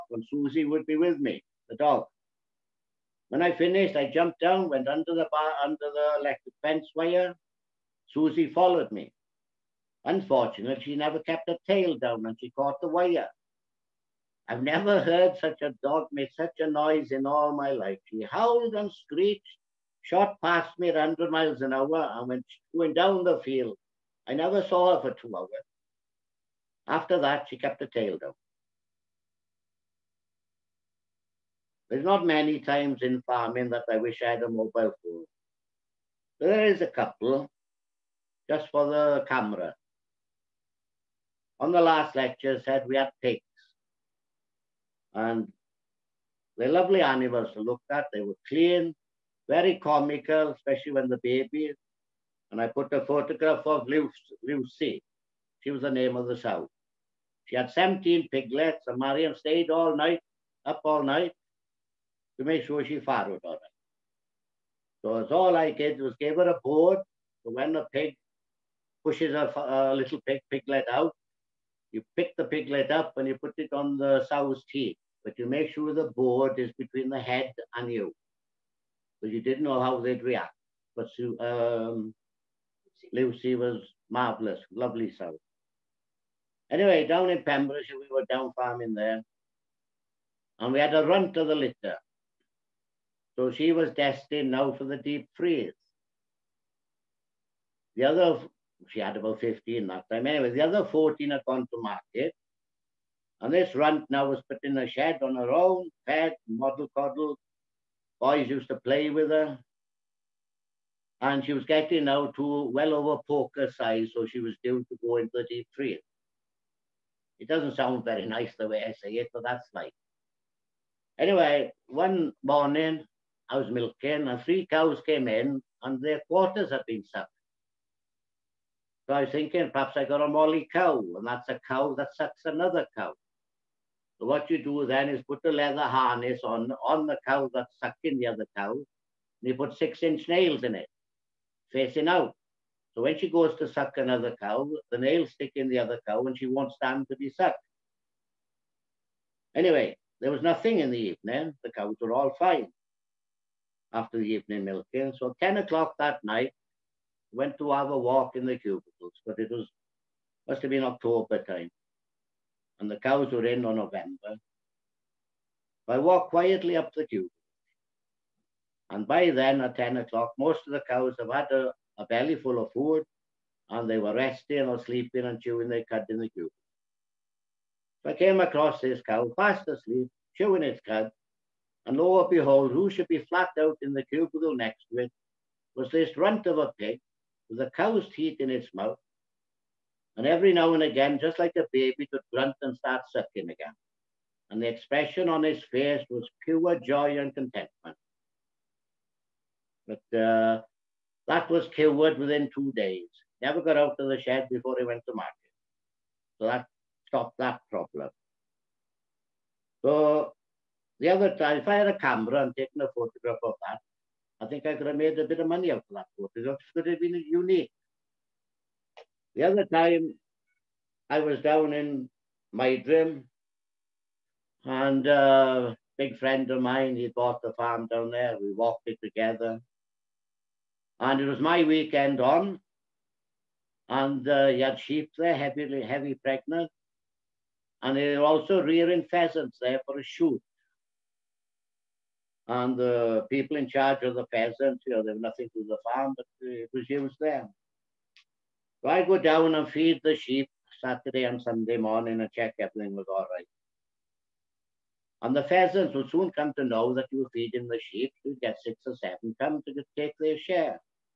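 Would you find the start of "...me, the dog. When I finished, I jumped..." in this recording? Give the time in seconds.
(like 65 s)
1 s.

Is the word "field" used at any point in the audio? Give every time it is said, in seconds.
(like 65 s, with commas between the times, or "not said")
23 s.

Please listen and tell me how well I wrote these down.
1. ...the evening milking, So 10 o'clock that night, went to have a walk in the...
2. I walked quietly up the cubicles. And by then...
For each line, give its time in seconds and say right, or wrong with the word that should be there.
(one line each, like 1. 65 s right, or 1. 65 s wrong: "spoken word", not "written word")
1. 154 s right
2. 165 s right.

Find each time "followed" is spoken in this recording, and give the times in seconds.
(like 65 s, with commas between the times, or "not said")
8 s, 63 s.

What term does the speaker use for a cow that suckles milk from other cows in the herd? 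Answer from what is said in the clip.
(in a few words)
molly cow.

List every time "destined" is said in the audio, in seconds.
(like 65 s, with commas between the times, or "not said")
93 s.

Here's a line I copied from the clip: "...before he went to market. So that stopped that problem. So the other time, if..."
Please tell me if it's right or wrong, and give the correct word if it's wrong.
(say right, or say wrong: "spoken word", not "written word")
right.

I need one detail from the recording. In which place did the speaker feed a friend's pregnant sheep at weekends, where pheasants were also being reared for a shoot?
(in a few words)
Meidrim.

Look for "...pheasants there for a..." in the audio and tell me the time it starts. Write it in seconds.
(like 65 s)
239 s.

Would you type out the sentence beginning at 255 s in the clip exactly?
And the pheasants would soon come to know that you were feeding the sheep.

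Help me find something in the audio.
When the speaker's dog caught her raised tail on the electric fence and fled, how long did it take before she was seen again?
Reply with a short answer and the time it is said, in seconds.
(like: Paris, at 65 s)
2 hours, at 25 s.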